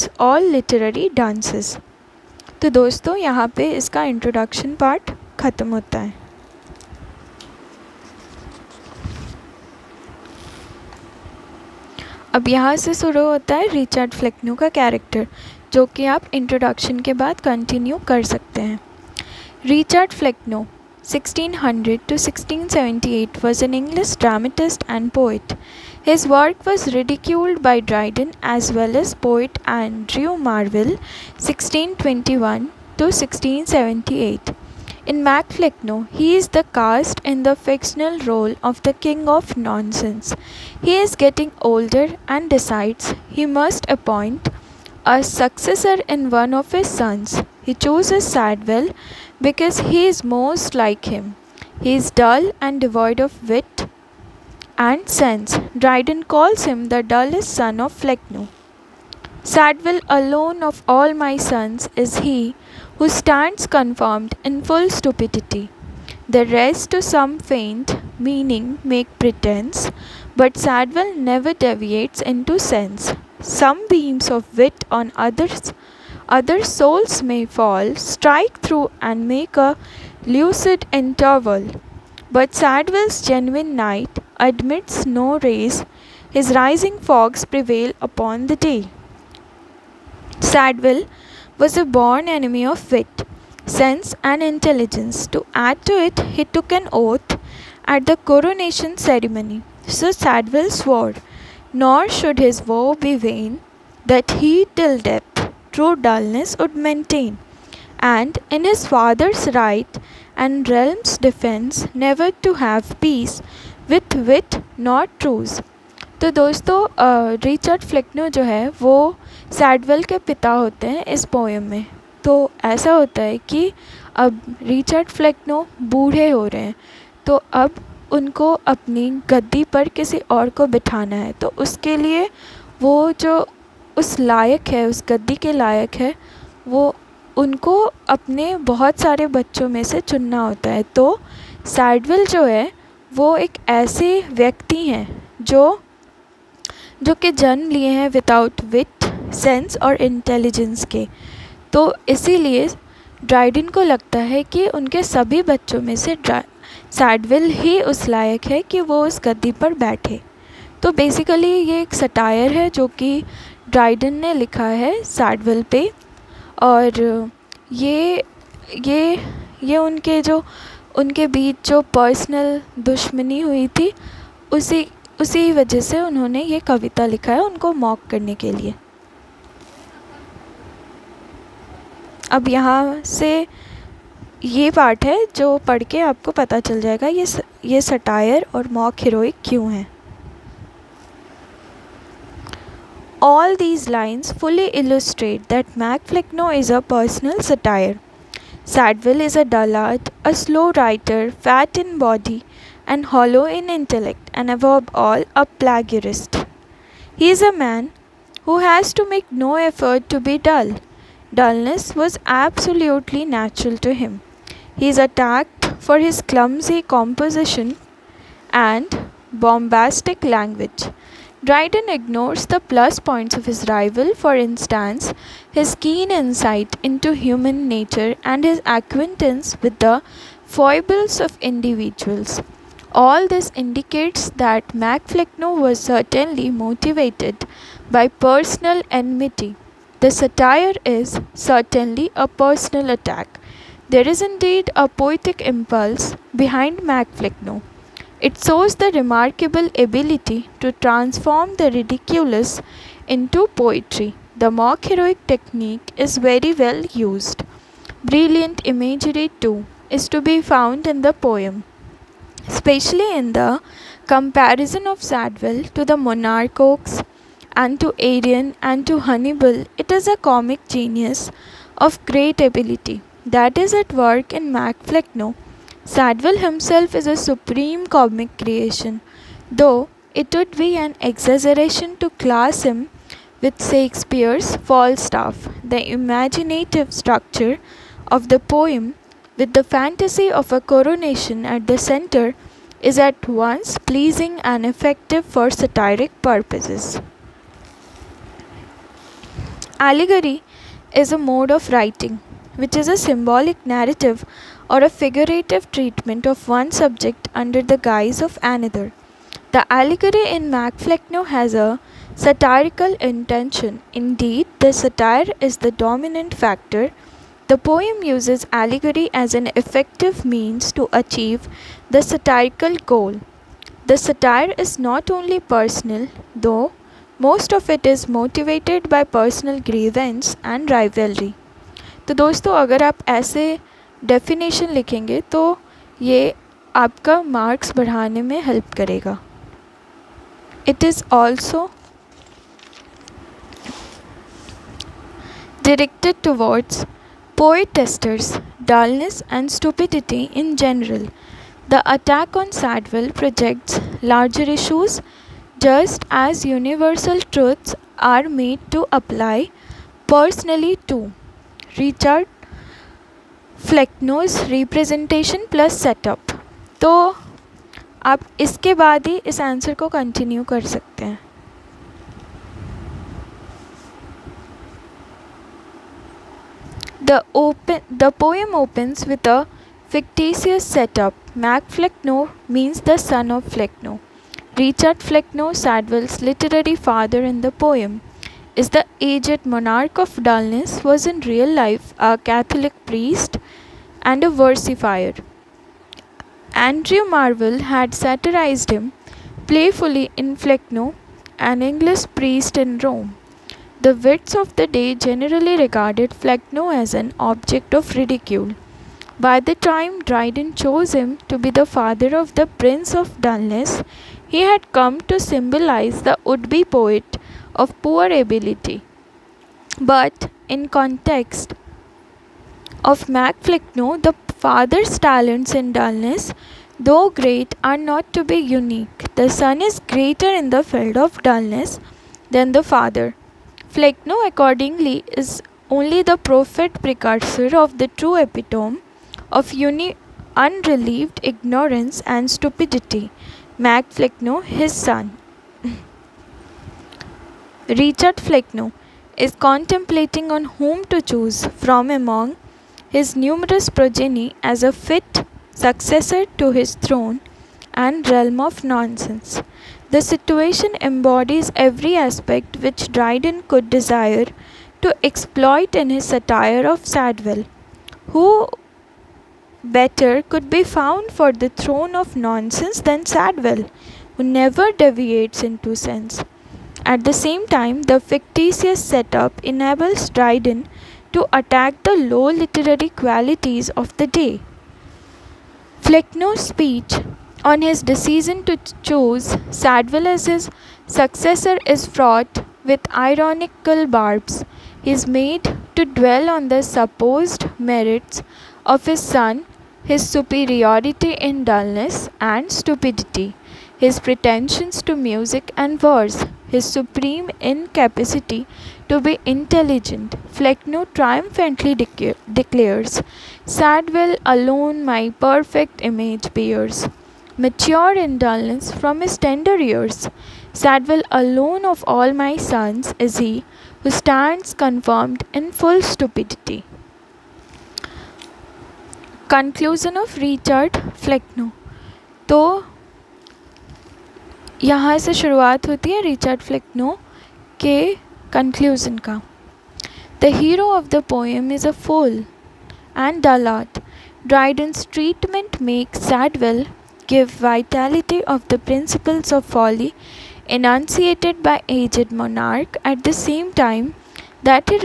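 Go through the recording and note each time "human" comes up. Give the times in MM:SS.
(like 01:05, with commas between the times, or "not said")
03:47.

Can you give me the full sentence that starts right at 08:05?
Flecknoe's speech on his decision to choose Sadwell as his successor is fraught with ironical barbs.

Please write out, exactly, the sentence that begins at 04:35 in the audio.
Sadwell himself is a supreme comic creation, though it would be an exaggeration to class him with Shakespeare's Falstaff.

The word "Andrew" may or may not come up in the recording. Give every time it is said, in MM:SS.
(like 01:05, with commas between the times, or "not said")
00:29, 06:36.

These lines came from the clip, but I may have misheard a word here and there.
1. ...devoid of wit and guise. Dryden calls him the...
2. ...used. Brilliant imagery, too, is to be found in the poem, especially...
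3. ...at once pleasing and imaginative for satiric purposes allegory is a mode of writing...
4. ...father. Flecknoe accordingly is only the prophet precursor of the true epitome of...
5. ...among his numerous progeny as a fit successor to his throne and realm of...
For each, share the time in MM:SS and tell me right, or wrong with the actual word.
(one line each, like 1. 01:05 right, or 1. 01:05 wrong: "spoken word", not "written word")
1. 00:52 wrong: "sense", not "guise"
2. 04:17 right
3. 04:52 wrong: "effective", not "imaginative"
4. 07:12 right
5. 07:31 right.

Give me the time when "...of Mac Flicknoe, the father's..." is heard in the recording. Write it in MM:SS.
07:02.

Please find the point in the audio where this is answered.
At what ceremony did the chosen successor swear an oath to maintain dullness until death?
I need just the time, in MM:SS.
01:38.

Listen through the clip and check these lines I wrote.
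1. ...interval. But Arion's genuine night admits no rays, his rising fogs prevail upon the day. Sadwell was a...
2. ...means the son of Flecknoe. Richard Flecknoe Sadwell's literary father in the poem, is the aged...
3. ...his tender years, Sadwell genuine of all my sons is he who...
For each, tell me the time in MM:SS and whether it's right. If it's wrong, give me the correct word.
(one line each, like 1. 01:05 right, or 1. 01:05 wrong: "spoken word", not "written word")
1. 01:20 wrong: "Sadwell", not "Arion"
2. 06:22 right
3. 08:39 wrong: "alone", not "genuine".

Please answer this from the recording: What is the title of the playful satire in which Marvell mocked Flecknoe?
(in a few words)
Flecknoe, an English Priest in Rome.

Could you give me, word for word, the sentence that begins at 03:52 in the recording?
All this indicates that Mac Flecknoe was certainly motivated by personal enmity.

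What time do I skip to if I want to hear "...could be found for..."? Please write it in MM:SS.
07:50.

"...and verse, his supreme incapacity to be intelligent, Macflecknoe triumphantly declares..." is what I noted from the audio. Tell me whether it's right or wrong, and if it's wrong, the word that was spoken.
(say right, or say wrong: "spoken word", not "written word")
wrong: "Flecknoe", not "Macflecknoe".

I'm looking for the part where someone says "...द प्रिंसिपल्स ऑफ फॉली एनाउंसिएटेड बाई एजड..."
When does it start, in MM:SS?
09:08.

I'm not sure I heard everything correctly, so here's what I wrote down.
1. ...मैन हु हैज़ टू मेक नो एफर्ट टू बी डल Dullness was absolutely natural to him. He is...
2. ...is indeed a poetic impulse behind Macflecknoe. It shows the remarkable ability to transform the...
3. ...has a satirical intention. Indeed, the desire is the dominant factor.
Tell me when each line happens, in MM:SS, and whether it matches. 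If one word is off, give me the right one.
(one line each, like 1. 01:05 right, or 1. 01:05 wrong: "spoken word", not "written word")
1. 03:27 right
2. 04:04 right
3. 05:11 wrong: "satire", not "desire".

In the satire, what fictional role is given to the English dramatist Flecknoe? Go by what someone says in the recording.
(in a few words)
King of nonsense.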